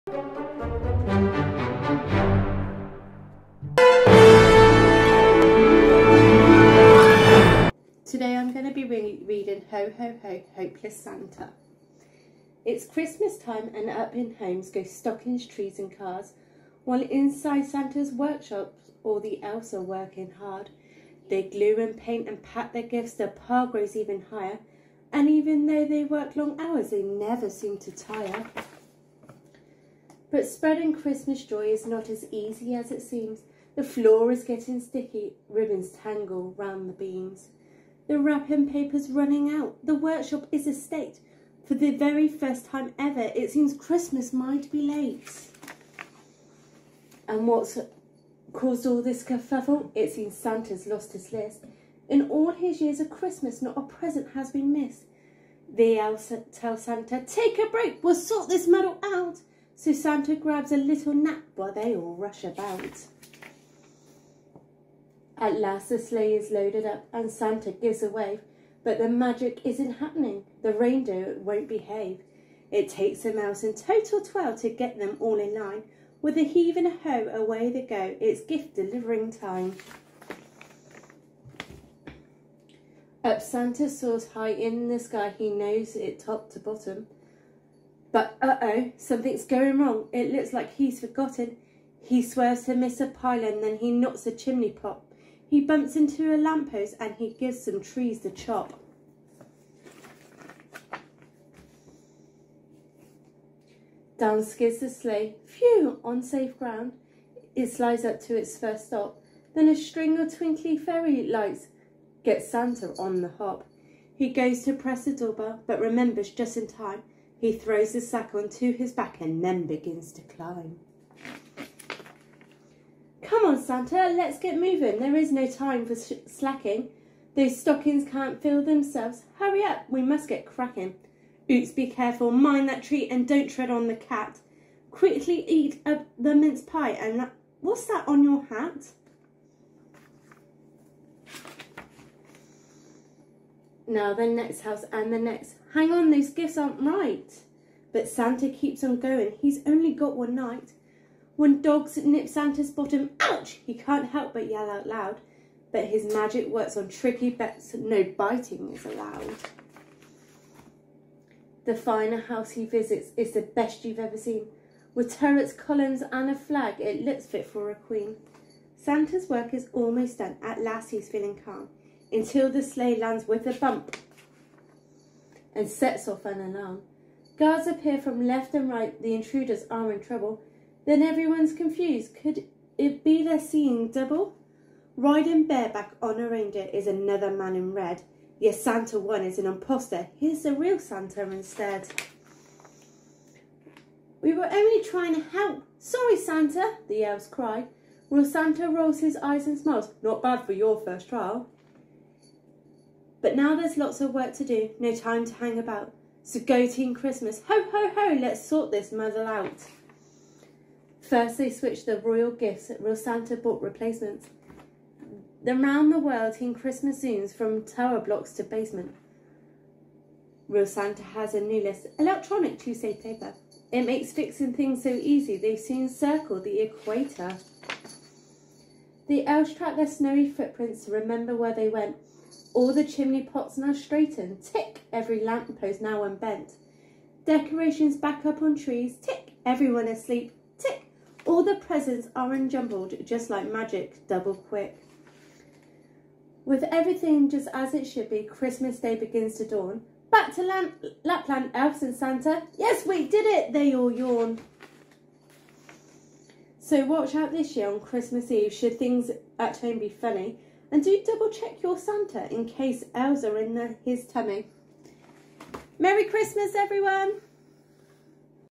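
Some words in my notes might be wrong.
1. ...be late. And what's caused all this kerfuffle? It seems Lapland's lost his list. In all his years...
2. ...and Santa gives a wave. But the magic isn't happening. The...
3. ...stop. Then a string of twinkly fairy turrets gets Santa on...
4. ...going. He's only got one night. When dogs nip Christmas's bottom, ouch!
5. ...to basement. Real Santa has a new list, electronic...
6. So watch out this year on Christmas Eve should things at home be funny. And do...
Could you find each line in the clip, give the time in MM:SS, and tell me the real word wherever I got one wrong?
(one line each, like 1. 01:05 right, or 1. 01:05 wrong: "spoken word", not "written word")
1. 00:44 wrong: "Santa", not "Lapland"
2. 01:07 right
3. 01:48 wrong: "lights", not "turrets"
4. 02:28 wrong: "Santa", not "Christmas"
5. 03:38 right
6. 04:16 right.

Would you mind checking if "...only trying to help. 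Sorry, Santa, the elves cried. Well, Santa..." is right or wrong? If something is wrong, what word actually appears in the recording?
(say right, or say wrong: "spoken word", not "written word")
right.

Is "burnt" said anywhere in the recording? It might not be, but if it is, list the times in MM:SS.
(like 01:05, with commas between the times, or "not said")
not said.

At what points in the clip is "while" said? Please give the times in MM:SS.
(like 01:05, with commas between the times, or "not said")
00:16, 01:01.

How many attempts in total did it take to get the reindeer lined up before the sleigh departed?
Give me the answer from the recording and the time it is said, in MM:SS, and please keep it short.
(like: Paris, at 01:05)
12, at 01:14.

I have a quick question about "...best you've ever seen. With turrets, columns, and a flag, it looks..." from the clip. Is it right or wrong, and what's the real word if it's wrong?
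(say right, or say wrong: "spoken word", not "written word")
right.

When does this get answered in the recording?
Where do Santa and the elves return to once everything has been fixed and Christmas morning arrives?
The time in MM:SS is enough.
04:11.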